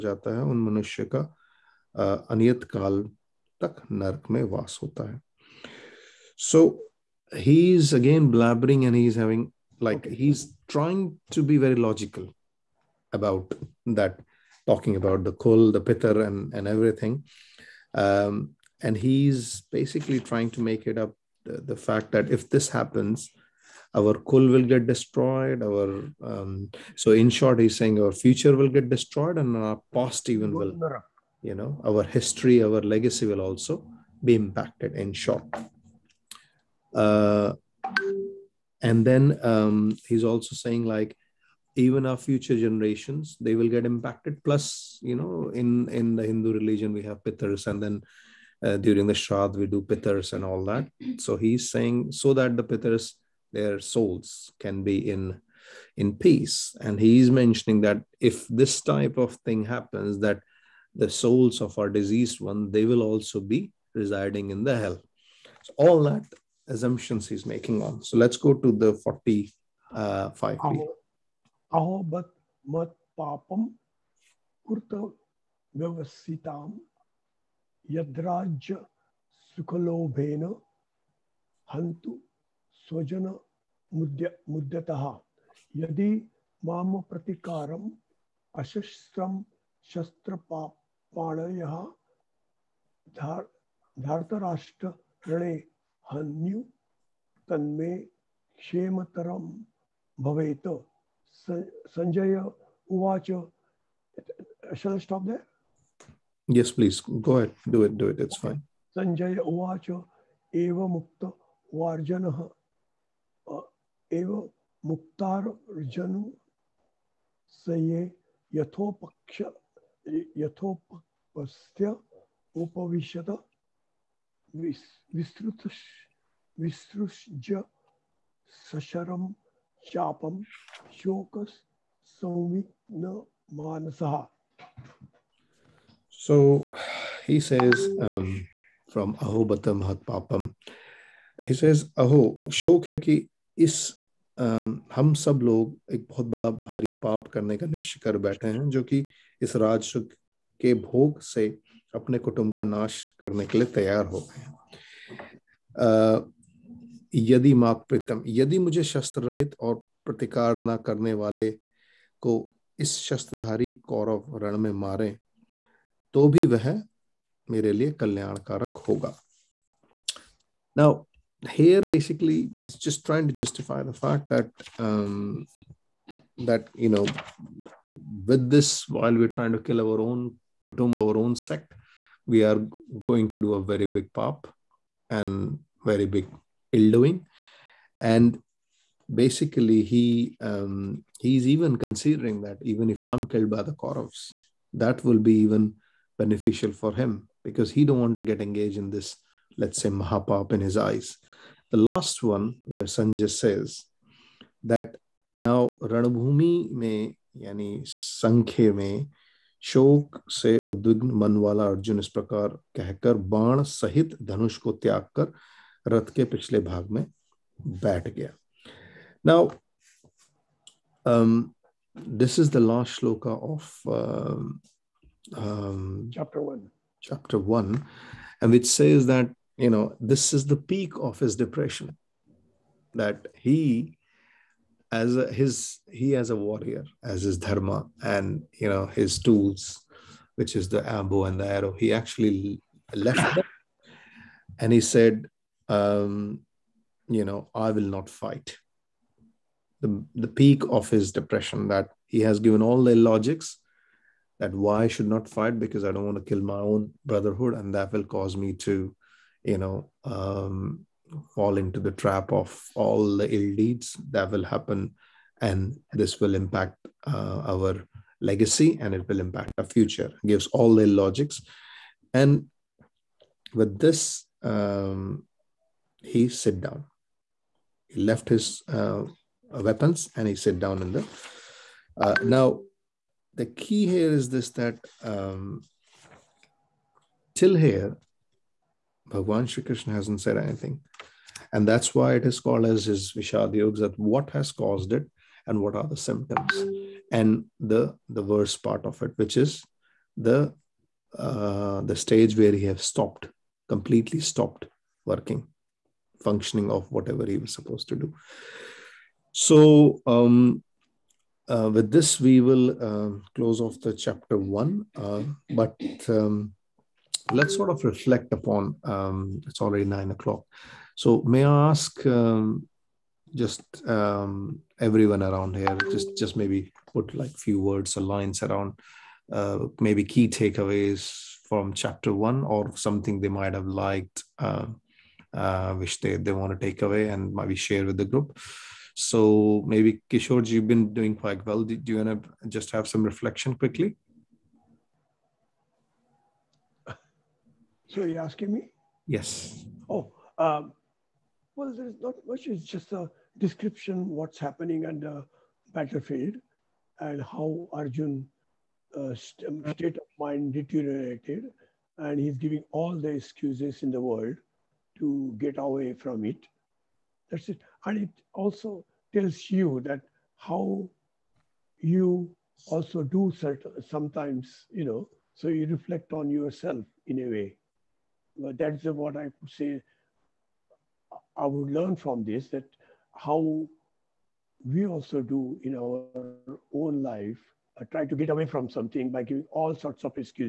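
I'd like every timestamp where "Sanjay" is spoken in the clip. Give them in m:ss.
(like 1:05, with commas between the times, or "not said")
3:22.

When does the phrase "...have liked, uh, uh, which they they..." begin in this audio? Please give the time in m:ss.
5:33.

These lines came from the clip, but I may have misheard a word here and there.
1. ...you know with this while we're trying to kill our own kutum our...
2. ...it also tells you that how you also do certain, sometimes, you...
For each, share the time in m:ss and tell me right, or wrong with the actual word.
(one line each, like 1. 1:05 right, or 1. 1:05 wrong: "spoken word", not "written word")
1. 2:56 right
2. 6:08 right.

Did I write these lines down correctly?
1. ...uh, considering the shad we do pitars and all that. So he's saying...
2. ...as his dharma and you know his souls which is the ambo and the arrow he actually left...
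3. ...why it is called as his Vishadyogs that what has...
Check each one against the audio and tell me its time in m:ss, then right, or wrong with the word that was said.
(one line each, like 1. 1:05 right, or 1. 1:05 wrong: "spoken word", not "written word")
1. 0:48 wrong: "during", not "considering"
2. 3:57 wrong: "tools", not "souls"
3. 4:51 right.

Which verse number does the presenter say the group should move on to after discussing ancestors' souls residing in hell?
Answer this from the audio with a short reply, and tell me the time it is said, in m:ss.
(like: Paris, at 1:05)
45, at 1:08.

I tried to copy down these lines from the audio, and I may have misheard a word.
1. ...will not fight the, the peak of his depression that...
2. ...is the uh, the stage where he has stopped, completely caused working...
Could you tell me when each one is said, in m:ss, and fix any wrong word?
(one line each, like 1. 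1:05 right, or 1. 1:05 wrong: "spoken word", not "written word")
1. 4:07 right
2. 4:59 wrong: "stopped", not "caused".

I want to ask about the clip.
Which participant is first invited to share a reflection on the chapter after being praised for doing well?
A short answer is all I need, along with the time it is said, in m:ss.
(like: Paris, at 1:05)
Kishore, at 5:40.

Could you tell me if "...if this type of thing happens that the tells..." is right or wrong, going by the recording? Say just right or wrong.
wrong.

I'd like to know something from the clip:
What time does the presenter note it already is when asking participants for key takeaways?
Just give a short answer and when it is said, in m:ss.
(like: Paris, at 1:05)
9 o'clock, at 5:19.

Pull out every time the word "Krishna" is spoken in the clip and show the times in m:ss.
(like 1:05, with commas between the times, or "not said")
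4:49.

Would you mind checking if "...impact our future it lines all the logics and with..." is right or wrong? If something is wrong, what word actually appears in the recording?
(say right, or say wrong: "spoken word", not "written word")
wrong: "gives", not "lines".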